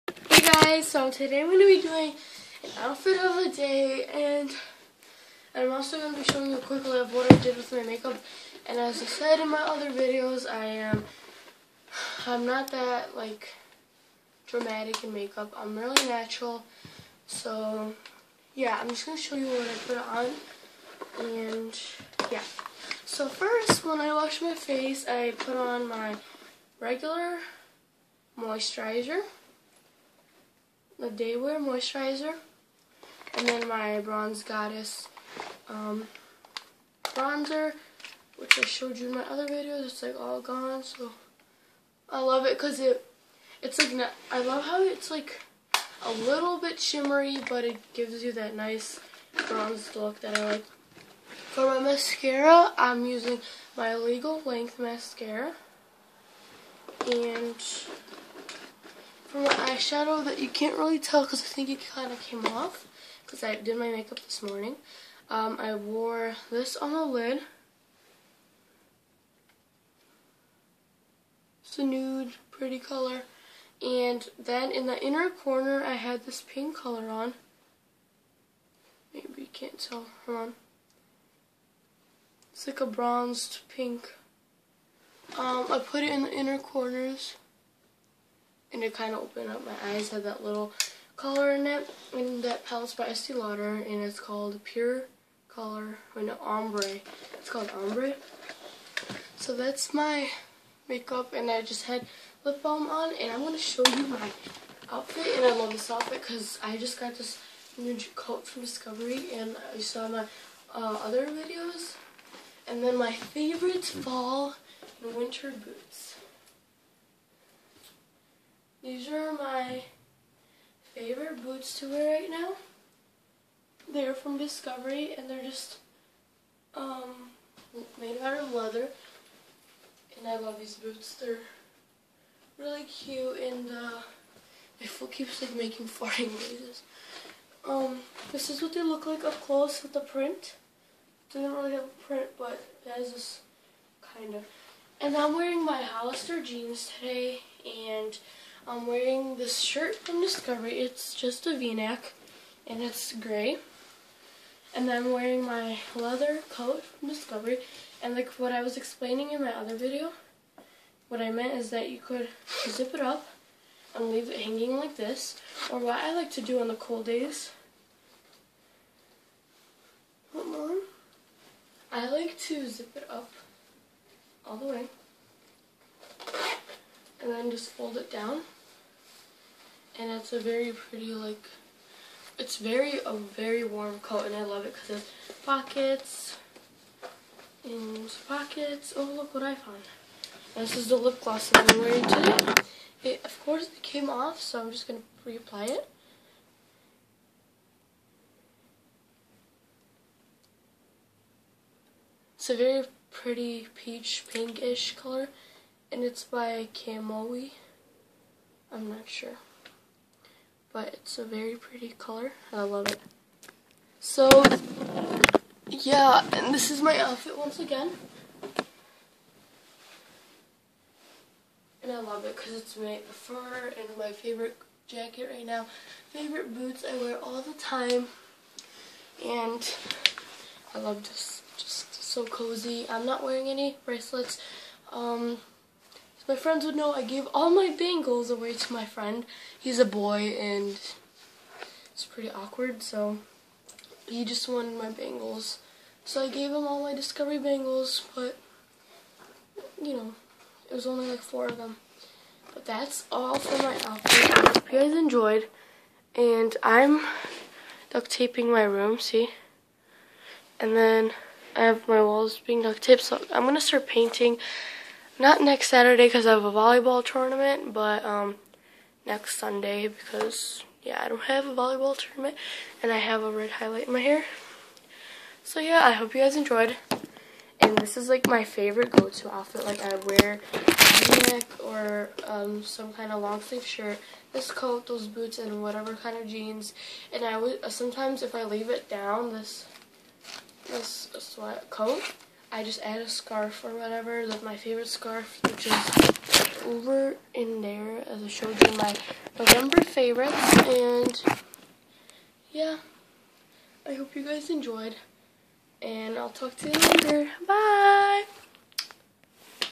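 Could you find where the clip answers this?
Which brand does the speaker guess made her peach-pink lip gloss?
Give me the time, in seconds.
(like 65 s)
206 s.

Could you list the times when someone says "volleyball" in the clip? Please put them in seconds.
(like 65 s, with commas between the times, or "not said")
266 s, 271 s.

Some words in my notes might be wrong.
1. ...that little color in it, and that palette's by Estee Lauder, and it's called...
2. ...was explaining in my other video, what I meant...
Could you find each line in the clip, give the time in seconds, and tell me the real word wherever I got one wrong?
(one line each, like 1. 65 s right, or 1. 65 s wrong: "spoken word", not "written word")
1. 90 s right
2. 158 s right.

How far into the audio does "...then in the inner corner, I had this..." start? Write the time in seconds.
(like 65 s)
74 s.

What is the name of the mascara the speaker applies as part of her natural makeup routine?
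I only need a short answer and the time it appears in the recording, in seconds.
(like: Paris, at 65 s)
Legal Length Mascara, at 53 s.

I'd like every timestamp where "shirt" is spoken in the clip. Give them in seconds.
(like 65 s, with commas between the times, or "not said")
149 s, 283 s.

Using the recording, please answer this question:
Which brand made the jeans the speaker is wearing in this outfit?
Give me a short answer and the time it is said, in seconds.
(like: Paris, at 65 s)
Hollister, at 145 s.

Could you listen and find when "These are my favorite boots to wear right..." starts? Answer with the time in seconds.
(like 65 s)
118 s.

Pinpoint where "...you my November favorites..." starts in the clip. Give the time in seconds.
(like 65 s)
298 s.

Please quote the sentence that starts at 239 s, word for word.
He's a boy and it's pretty awkward, so he just wanted my bangles.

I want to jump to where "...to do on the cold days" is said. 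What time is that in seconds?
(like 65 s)
166 s.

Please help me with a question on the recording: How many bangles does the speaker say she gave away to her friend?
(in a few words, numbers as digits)
4.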